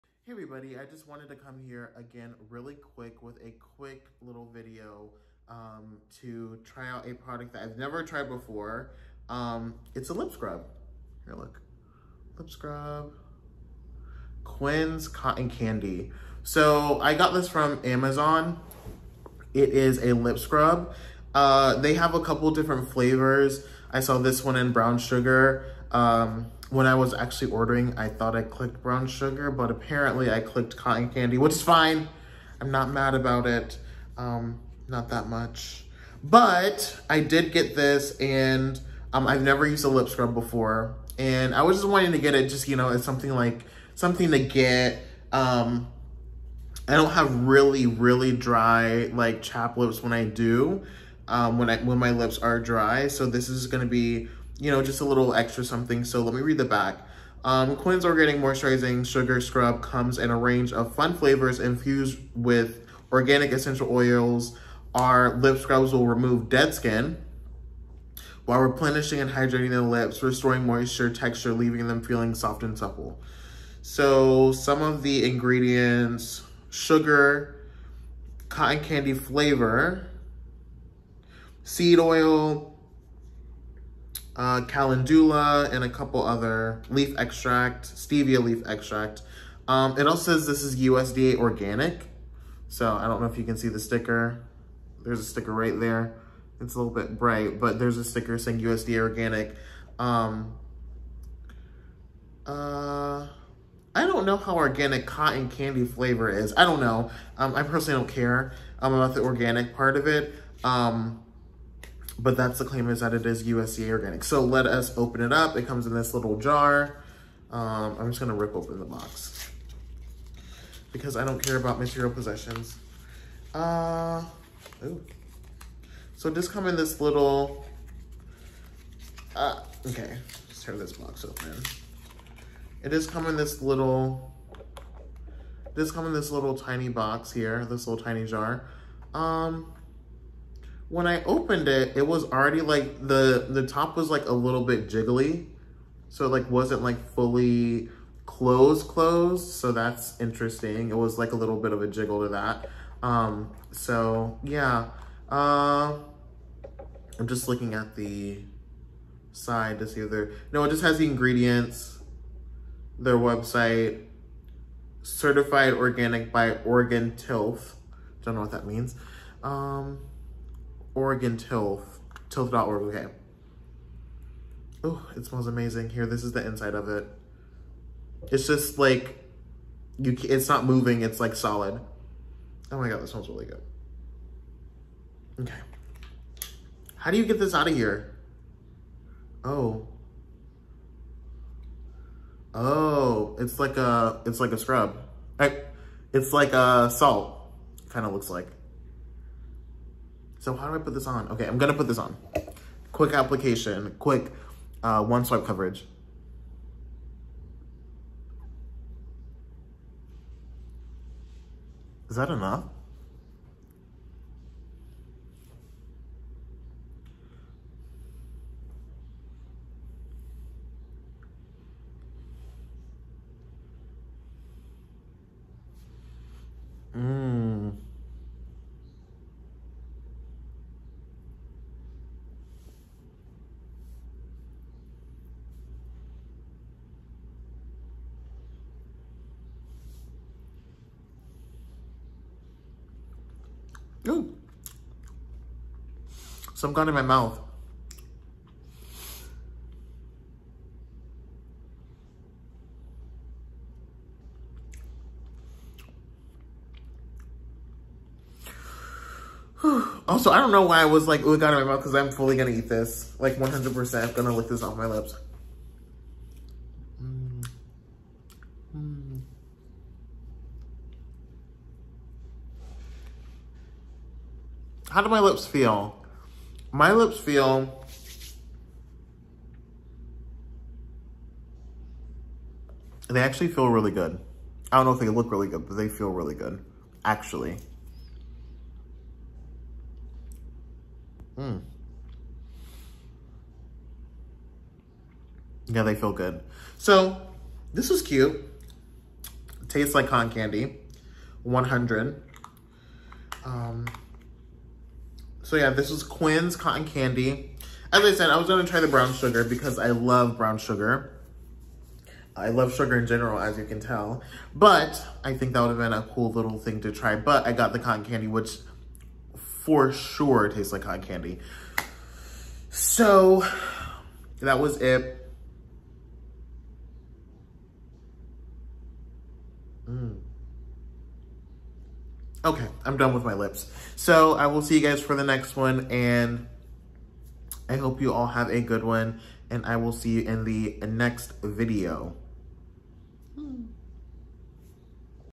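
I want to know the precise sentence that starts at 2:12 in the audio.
It just come in this little, This come in this little tiny box here, this little tiny jar.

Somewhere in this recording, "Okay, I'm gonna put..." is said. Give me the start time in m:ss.
3:21.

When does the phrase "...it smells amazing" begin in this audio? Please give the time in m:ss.
2:55.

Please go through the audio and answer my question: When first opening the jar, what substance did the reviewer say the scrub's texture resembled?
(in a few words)
salt.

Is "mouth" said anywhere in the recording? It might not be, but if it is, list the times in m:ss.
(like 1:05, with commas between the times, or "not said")
4:07, 4:21.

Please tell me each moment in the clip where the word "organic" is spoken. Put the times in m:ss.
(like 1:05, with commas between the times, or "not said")
0:58, 1:03, 1:31, 1:38, 1:44, 1:49, 1:53, 2:45.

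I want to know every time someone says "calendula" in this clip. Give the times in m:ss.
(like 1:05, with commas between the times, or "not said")
1:24.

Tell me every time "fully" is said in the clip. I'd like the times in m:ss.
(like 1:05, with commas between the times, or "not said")
2:27, 4:22.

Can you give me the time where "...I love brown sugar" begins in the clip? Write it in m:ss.
5:09.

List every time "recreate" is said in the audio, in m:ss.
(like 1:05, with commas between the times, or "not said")
not said.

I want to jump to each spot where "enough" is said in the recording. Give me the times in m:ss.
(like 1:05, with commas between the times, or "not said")
3:32.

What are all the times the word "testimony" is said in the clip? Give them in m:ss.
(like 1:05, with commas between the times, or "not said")
not said.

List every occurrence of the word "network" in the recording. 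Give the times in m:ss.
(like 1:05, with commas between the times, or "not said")
not said.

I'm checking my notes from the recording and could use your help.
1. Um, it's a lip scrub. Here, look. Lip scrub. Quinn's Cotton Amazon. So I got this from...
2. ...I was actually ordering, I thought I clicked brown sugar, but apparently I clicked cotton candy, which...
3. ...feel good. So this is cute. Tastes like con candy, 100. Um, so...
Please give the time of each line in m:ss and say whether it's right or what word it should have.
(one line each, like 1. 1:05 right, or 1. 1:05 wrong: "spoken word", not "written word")
1. 0:09 wrong: "Candy", not "Amazon"
2. 0:26 right
3. 4:55 right.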